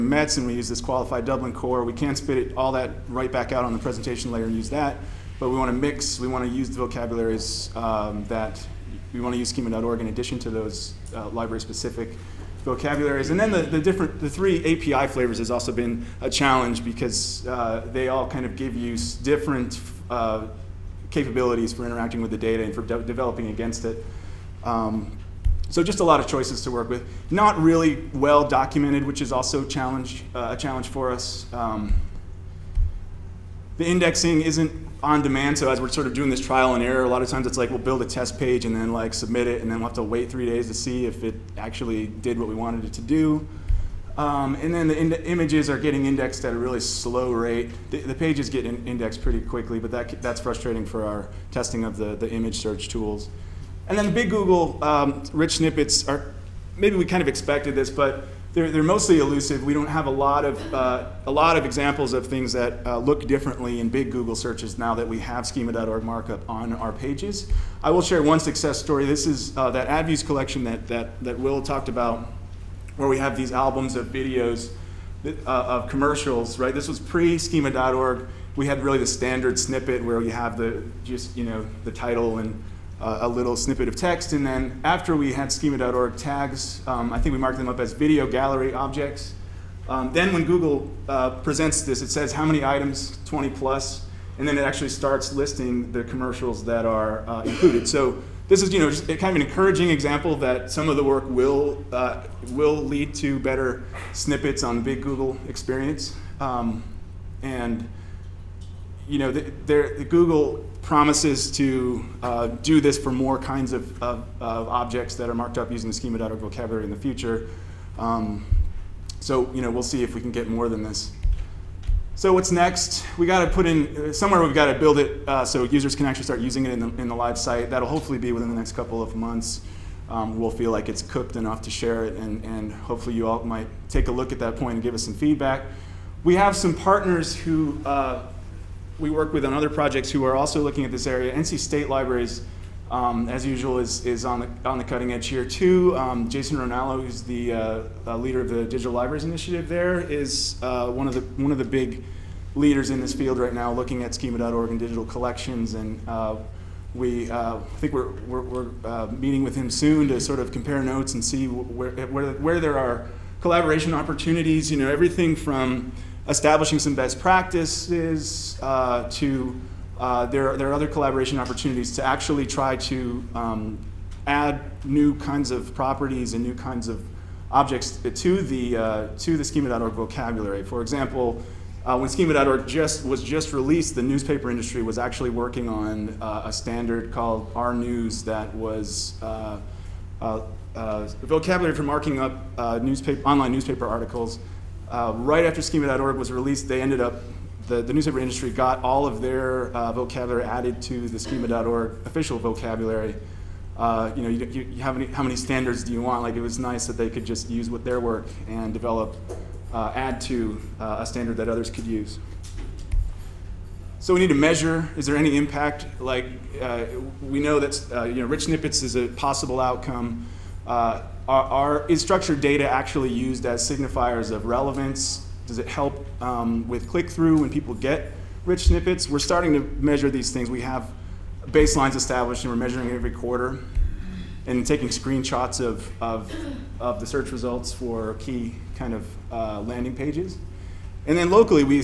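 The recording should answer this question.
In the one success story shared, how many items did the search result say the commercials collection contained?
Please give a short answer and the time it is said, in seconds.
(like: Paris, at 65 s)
20 plus, at 93 s.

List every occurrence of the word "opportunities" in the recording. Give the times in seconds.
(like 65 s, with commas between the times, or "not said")
163 s, 171 s.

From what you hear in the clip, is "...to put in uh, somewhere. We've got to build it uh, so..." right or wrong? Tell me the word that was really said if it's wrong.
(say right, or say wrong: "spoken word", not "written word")
right.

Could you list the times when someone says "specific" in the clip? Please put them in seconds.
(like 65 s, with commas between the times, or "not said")
11 s.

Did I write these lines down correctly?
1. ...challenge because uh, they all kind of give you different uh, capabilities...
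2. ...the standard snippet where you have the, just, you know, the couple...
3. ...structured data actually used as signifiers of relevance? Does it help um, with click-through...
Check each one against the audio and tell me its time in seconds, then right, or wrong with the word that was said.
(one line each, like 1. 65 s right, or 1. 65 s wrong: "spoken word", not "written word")
1. 16 s right
2. 78 s wrong: "title", not "couple"
3. 221 s right.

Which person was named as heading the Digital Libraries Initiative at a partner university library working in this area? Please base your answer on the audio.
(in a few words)
Jason Ronallo.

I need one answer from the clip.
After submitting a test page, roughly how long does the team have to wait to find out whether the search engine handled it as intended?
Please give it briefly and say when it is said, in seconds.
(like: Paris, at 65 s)
3 days, at 40 s.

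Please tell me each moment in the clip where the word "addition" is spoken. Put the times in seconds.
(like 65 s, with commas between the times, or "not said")
10 s.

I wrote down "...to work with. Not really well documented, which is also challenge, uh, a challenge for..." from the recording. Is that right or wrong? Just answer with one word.
right.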